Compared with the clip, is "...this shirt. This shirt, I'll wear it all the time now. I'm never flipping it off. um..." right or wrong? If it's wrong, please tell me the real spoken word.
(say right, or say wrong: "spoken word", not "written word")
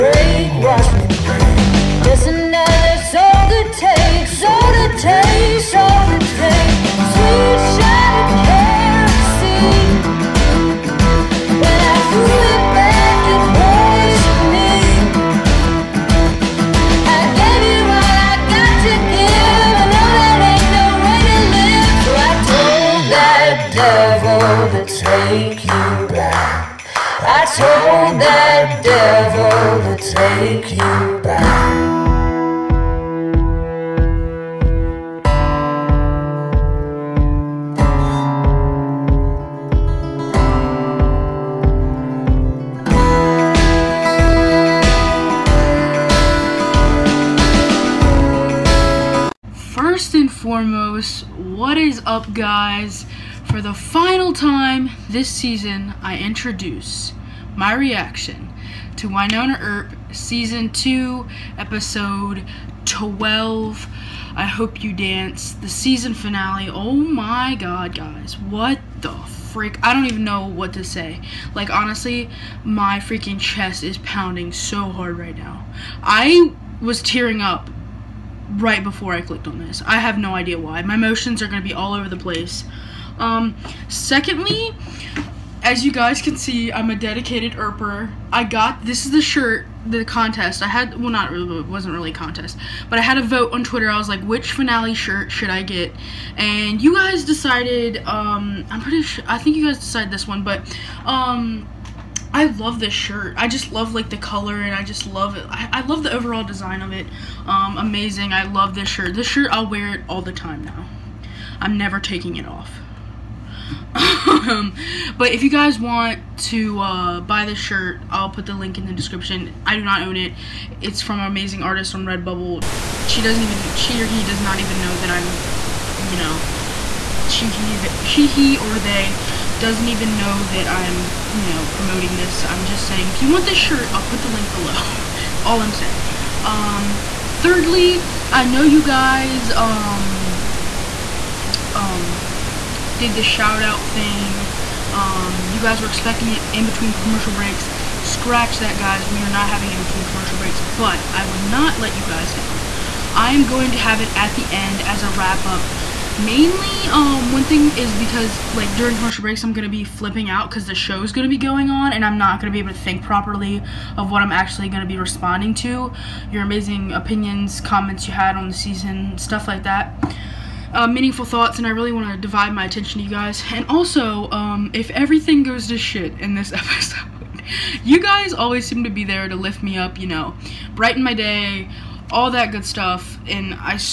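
wrong: "taking", not "flipping".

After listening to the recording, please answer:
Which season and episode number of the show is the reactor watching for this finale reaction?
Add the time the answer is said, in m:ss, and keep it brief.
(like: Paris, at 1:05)
Season 2, Episode 12, at 1:00.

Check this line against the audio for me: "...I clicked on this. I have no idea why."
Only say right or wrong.
right.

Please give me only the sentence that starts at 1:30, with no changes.
I had, well not really, it wasn't really a contest, but I had a vote on Twitter.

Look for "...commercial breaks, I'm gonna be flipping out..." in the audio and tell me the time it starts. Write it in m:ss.
2:38.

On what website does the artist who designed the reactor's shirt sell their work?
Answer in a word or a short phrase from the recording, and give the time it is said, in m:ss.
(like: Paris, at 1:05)
Redbubble, at 2:02.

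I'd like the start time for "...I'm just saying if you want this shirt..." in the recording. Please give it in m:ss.
2:12.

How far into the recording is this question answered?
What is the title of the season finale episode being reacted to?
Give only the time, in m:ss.
1:04.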